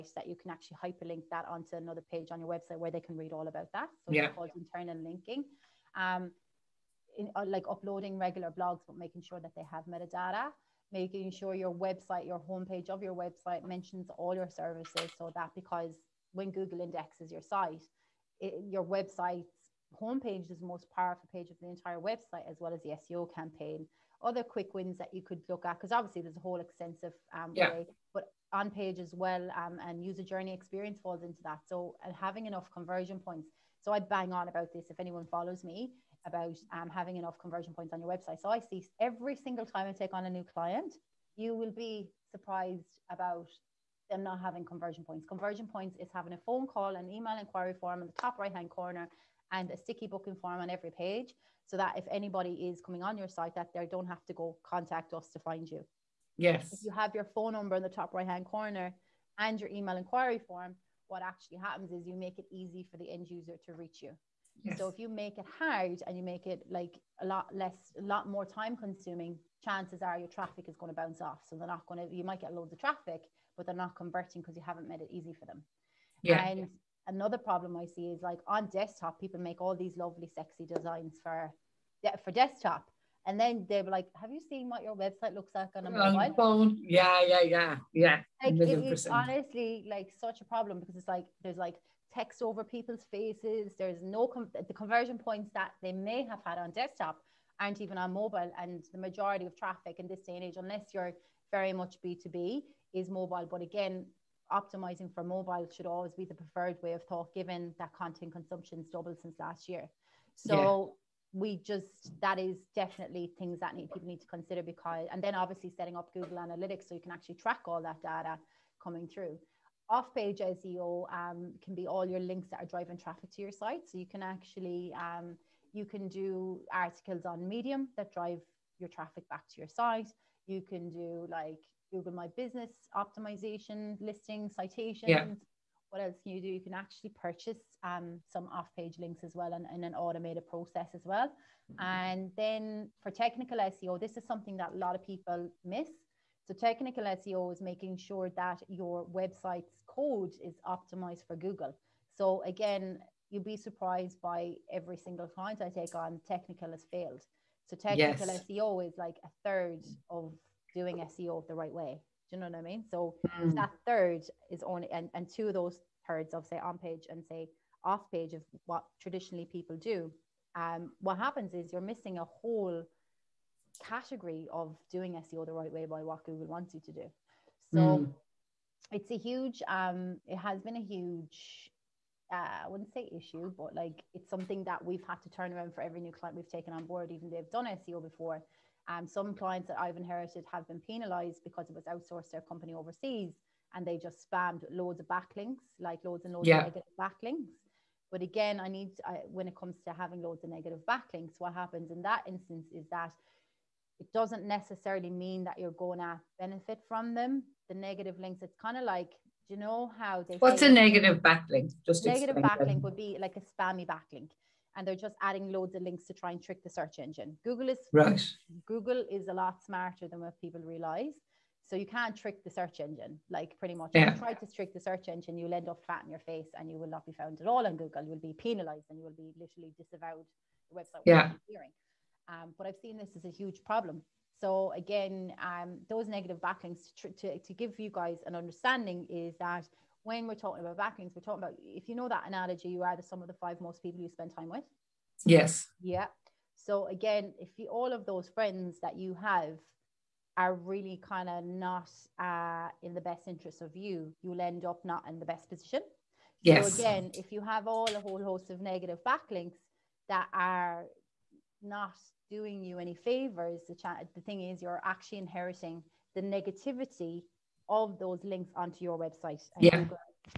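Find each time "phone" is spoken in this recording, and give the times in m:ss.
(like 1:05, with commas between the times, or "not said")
0:46, 0:57, 1:26.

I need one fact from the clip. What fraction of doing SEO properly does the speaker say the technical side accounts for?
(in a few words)
a third.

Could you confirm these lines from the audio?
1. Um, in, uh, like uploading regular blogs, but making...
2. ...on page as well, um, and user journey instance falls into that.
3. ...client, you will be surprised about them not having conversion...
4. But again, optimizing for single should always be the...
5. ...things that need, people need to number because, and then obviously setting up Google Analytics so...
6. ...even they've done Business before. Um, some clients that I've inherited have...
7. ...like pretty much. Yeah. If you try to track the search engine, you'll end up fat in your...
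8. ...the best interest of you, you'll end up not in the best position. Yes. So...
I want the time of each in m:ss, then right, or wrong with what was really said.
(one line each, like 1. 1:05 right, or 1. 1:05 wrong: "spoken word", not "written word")
1. 0:05 right
2. 0:28 wrong: "experience", not "instance"
3. 0:40 right
4. 1:43 wrong: "mobile", not "single"
5. 1:53 wrong: "consider", not "number"
6. 3:07 wrong: "SEO", not "Business"
7. 3:43 wrong: "trick", not "track"
8. 4:12 right.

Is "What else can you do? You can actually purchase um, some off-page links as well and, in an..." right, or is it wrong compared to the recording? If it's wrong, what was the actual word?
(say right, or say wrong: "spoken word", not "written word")
right.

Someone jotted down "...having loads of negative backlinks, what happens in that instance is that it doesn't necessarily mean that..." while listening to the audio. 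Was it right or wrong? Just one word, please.
right.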